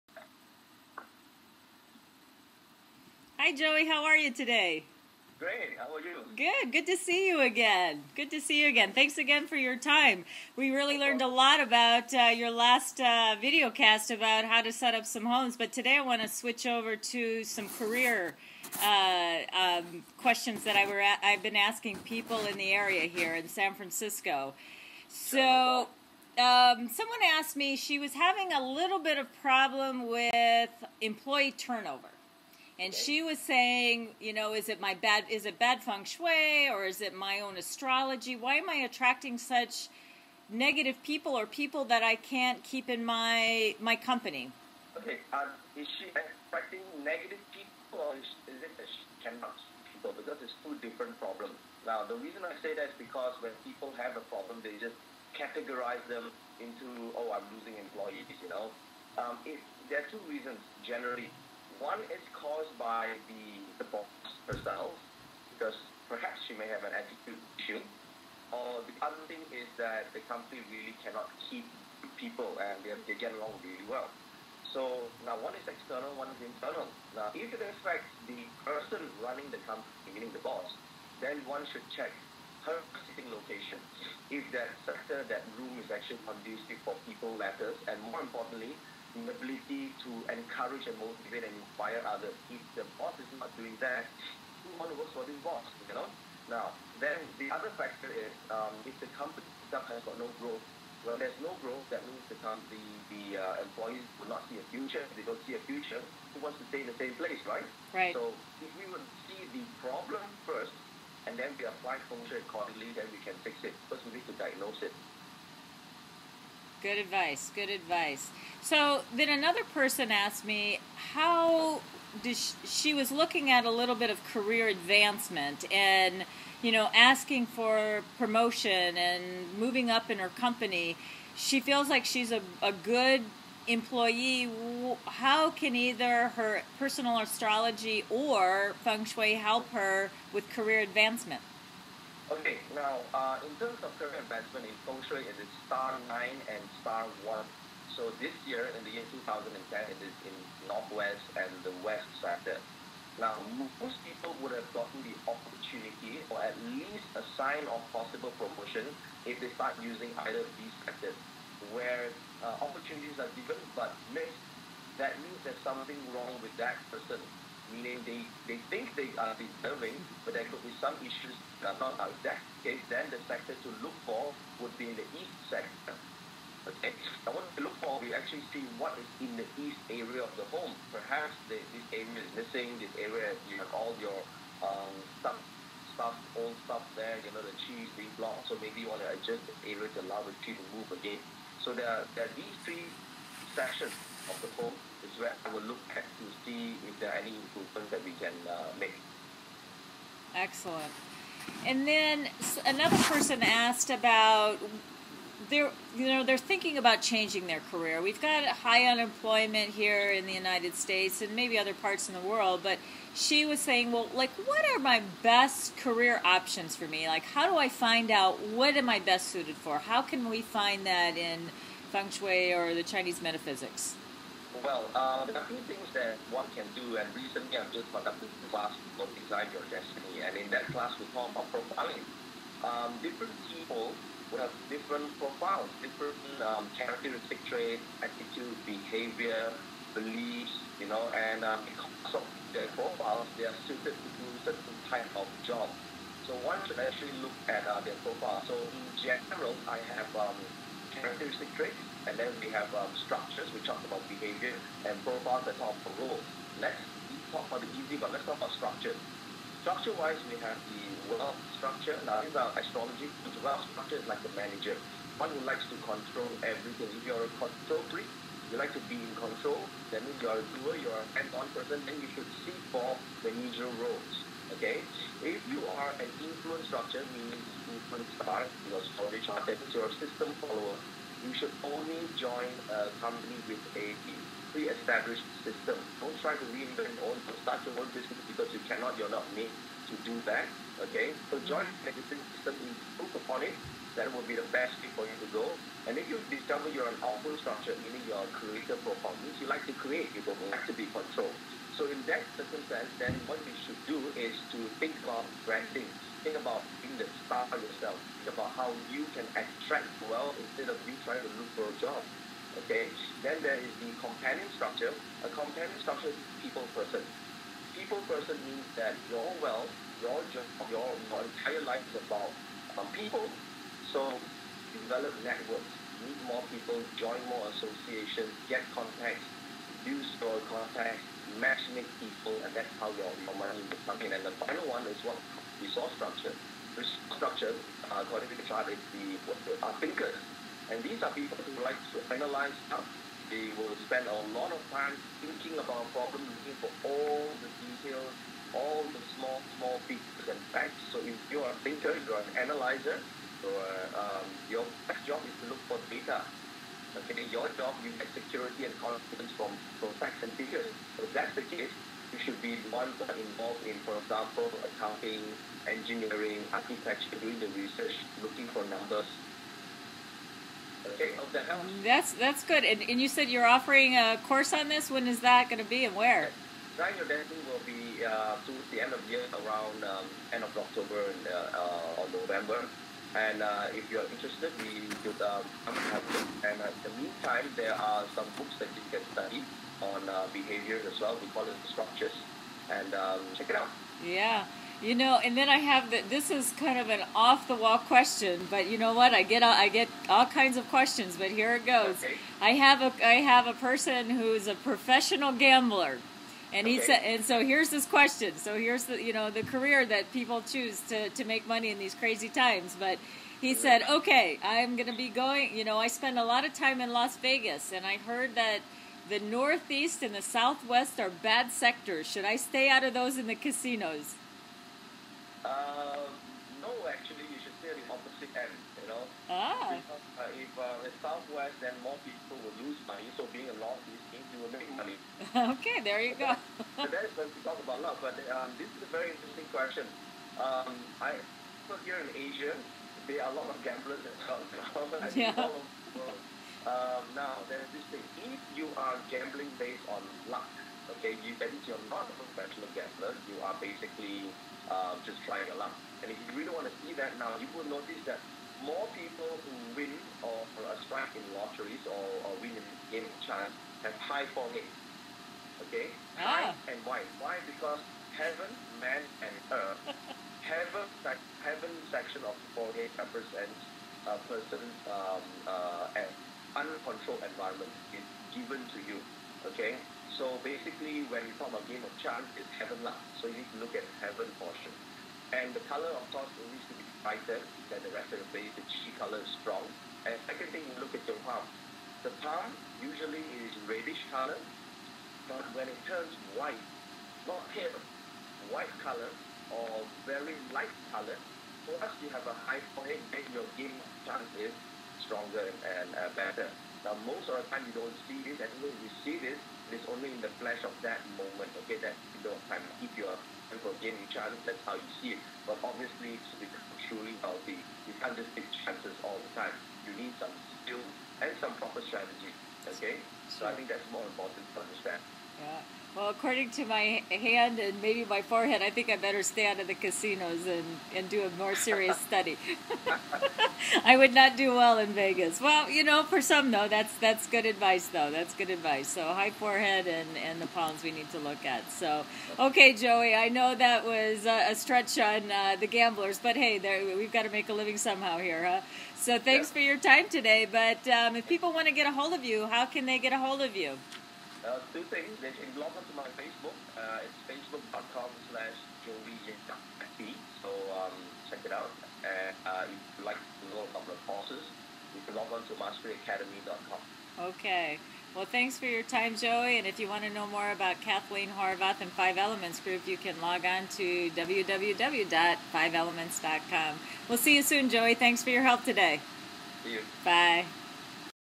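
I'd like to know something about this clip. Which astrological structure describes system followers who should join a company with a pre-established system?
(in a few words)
Influence structure.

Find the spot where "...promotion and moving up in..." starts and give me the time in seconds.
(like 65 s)
128 s.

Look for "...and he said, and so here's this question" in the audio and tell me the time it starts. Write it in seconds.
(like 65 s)
406 s.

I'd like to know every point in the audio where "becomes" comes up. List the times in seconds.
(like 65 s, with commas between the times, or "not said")
333 s, 516 s.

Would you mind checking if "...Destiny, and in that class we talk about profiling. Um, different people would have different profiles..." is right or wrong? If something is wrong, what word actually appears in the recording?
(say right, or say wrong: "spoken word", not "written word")
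right.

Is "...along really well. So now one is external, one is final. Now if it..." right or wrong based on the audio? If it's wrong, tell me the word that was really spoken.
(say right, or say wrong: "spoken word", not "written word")
wrong: "internal", not "final".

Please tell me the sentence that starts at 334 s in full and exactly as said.
And the final one is what resource structure.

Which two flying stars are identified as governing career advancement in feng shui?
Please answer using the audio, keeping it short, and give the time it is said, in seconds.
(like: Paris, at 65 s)
Star 9 and star 1, at 145 s.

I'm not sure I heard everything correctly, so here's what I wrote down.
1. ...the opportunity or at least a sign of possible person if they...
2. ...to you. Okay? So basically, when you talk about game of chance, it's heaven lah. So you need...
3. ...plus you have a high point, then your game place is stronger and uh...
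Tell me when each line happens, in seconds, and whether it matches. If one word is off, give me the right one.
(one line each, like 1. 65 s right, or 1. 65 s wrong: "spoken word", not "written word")
1. 155 s wrong: "promotion", not "person"
2. 478 s right
3. 501 s wrong: "chance", not "place".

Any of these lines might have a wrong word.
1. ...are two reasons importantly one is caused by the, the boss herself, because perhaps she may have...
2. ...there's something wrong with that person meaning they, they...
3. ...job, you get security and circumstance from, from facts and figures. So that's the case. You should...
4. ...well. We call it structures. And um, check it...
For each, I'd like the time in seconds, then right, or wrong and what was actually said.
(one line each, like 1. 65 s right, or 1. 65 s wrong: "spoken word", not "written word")
1. 60 s wrong: "generally", not "importantly"
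2. 165 s right
3. 357 s wrong: "confidence", not "circumstance"
4. 391 s right.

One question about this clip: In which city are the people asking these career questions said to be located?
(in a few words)
San Francisco.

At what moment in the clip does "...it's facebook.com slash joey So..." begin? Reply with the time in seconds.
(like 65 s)
557 s.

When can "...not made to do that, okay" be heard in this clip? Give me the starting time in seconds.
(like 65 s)
289 s.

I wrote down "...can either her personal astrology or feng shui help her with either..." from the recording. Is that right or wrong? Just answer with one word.
wrong.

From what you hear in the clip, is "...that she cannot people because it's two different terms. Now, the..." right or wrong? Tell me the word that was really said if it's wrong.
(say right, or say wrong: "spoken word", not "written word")
wrong: "problems", not "terms".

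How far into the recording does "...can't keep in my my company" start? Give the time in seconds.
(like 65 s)
42 s.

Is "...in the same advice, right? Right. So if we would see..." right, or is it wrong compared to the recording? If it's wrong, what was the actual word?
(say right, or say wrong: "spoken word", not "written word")
wrong: "place", not "advice".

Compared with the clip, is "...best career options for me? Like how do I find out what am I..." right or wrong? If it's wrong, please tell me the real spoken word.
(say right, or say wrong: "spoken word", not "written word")
right.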